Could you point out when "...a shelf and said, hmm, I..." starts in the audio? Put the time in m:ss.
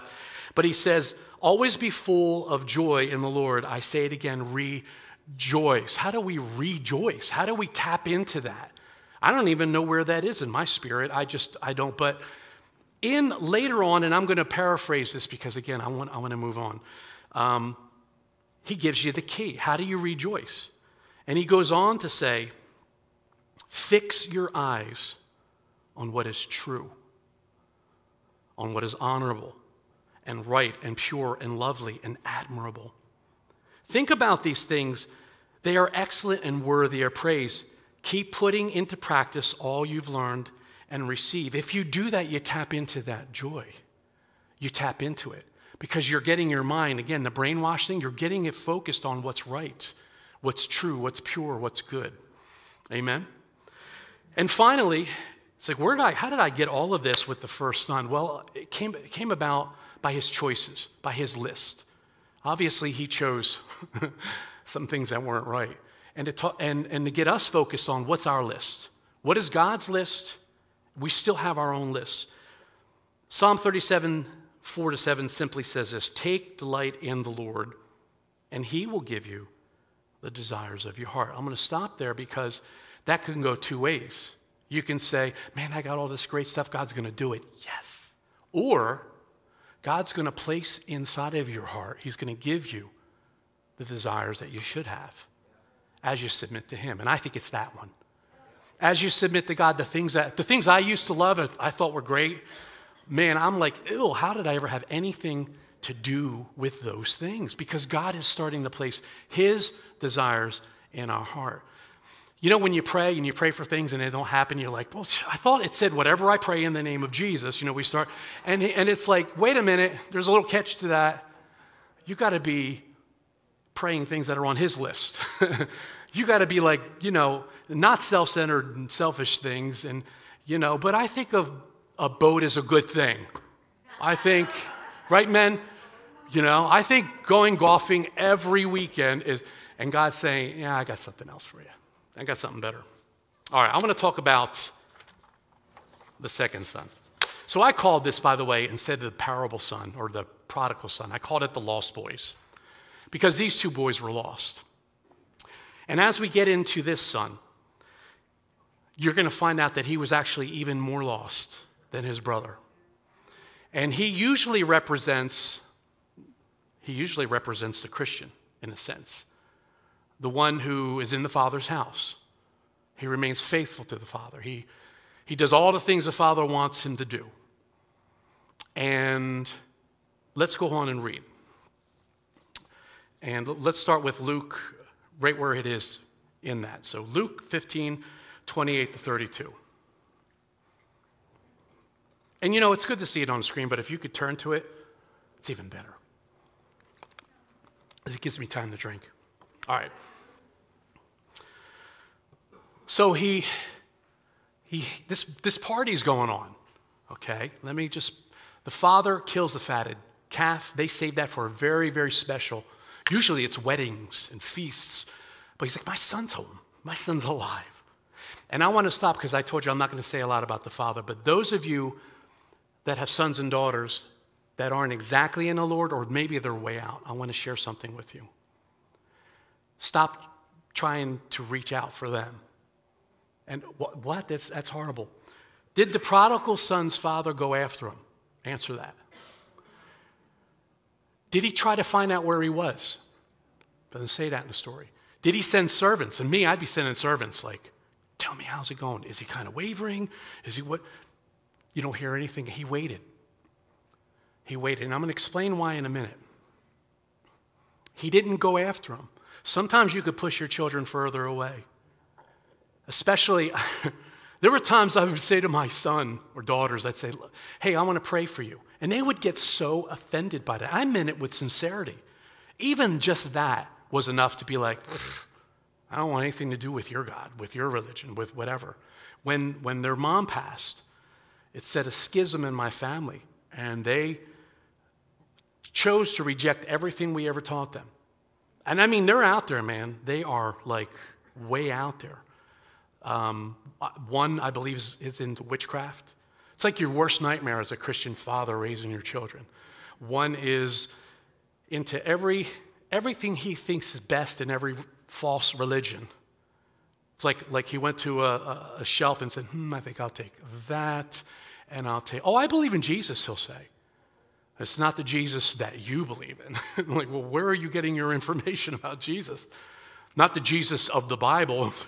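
5:08.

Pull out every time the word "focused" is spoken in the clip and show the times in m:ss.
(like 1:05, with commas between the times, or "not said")
0:48, 1:07.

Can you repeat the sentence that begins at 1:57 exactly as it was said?
You know, we start, and, and it's like, wait a minute, there's a little catch to that.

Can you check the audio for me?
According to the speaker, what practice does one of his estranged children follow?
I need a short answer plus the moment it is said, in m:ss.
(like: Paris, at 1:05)
Witchcraft, at 4:55.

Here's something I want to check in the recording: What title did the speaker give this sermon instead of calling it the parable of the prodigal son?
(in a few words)
The lost boys.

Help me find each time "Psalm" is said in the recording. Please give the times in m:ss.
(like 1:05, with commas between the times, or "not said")
1:13.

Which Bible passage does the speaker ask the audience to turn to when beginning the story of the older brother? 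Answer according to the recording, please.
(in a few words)
Luke 15:28-32.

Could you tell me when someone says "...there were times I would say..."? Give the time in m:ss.
4:24.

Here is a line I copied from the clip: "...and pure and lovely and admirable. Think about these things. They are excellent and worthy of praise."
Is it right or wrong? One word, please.
right.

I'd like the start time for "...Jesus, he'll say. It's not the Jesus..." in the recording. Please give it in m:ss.
5:12.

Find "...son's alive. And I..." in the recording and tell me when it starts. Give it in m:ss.
3:36.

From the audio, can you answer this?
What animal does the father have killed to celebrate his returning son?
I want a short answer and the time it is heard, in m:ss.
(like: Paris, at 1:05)
Fatted calf, at 3:29.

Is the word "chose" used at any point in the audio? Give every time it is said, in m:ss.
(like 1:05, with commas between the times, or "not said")
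1:03, 4:45.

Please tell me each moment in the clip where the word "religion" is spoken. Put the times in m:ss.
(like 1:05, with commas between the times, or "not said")
4:37, 5:05.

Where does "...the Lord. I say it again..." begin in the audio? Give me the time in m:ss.
0:03.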